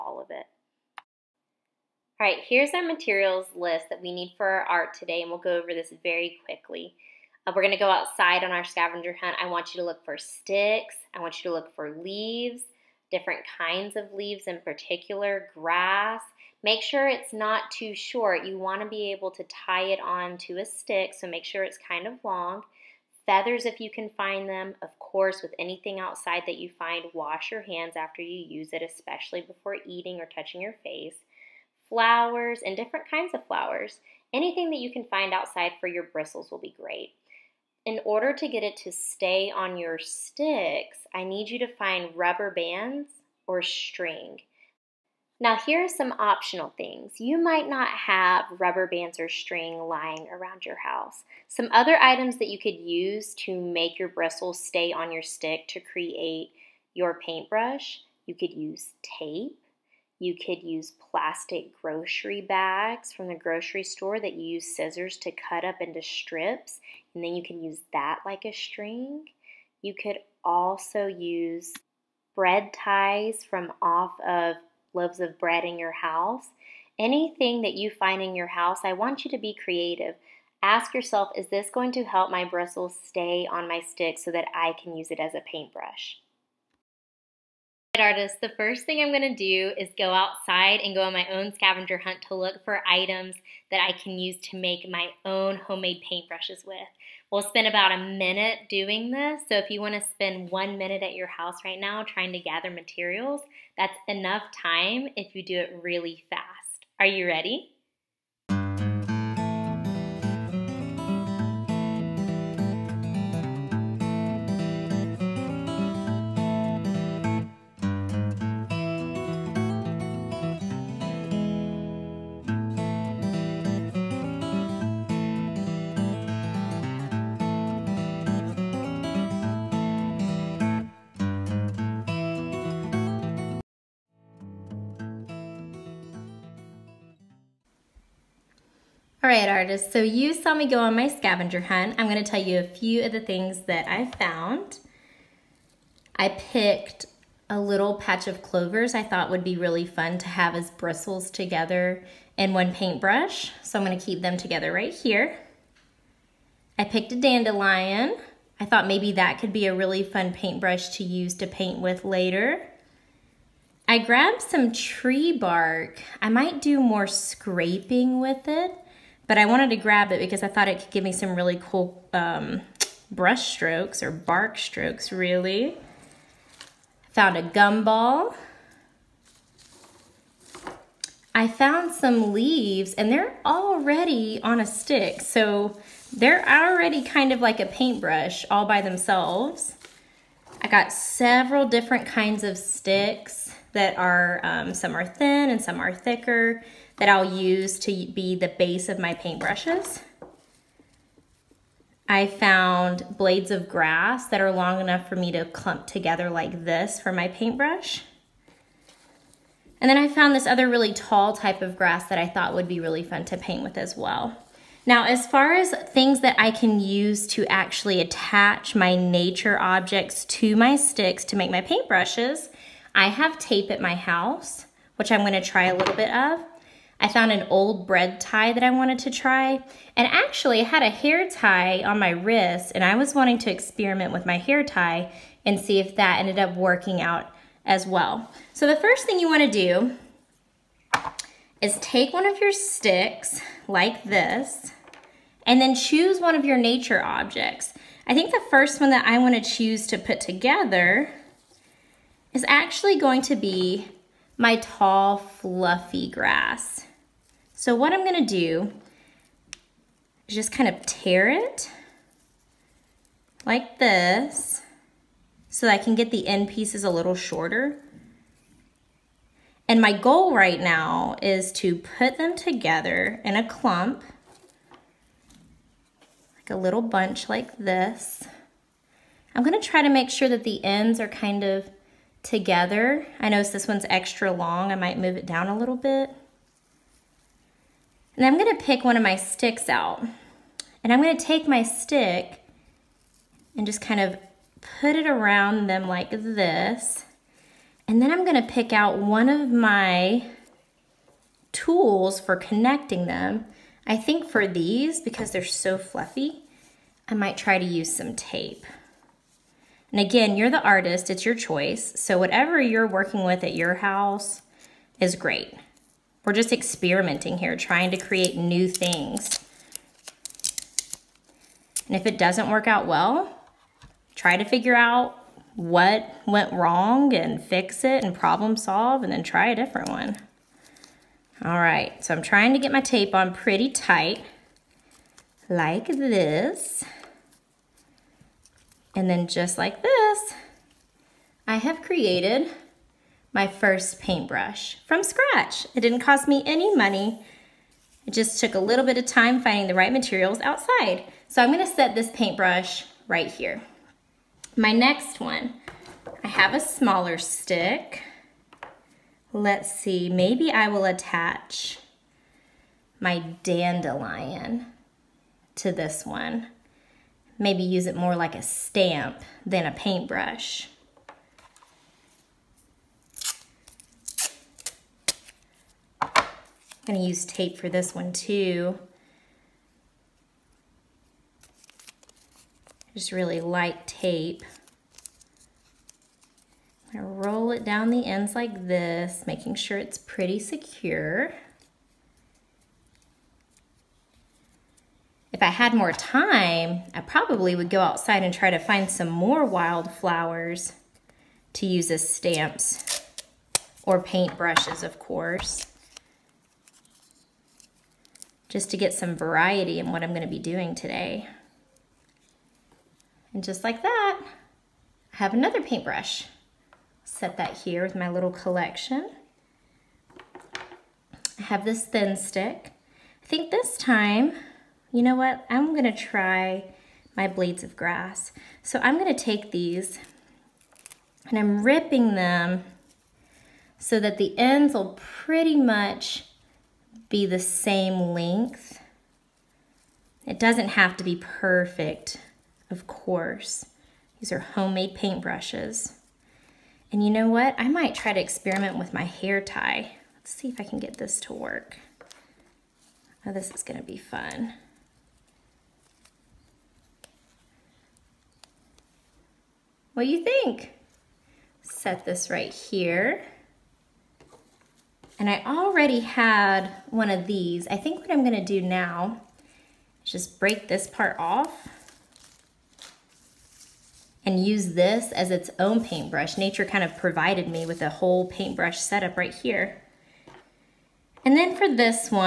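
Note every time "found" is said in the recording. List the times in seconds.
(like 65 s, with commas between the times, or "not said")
144 s, 177 s, 181 s, 202 s, 210 s, 227 s.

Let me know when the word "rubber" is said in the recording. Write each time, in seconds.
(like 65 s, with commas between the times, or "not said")
42 s, 48 s.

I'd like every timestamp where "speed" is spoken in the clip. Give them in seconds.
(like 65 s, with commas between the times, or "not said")
not said.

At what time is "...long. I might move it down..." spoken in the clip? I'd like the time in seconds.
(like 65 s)
284 s.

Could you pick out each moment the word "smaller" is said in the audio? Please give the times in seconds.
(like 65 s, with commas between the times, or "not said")
356 s.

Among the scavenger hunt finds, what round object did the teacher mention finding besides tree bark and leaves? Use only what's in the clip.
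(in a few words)
A gumball.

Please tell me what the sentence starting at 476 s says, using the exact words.
Nature kind of provided me with a whole paintbrush setup right here.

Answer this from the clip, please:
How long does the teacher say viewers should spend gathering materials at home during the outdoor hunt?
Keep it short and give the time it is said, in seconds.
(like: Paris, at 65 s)
One minute, at 100 s.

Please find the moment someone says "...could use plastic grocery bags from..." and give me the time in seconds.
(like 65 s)
60 s.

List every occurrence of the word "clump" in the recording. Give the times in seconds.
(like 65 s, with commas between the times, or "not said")
205 s, 273 s.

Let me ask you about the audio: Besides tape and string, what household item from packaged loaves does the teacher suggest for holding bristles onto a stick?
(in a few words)
Bread ties.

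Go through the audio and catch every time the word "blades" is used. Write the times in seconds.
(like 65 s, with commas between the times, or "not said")
203 s, 427 s.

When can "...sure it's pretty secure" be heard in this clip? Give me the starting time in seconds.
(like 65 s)
389 s.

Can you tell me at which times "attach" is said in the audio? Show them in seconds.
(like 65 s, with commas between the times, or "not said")
218 s, 360 s.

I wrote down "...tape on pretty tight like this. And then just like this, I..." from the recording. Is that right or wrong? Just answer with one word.
right.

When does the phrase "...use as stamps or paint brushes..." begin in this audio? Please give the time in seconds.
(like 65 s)
401 s.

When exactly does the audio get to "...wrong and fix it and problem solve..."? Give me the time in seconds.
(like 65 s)
326 s.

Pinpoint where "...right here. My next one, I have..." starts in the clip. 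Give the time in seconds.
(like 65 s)
353 s.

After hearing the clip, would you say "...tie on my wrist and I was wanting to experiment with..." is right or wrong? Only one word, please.
right.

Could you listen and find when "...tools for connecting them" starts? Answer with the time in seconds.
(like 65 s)
301 s.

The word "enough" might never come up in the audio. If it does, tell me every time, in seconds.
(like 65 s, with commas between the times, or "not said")
104 s, 204 s.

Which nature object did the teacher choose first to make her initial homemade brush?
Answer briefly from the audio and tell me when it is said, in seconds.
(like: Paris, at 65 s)
Tall, fluffy grass, at 254 s.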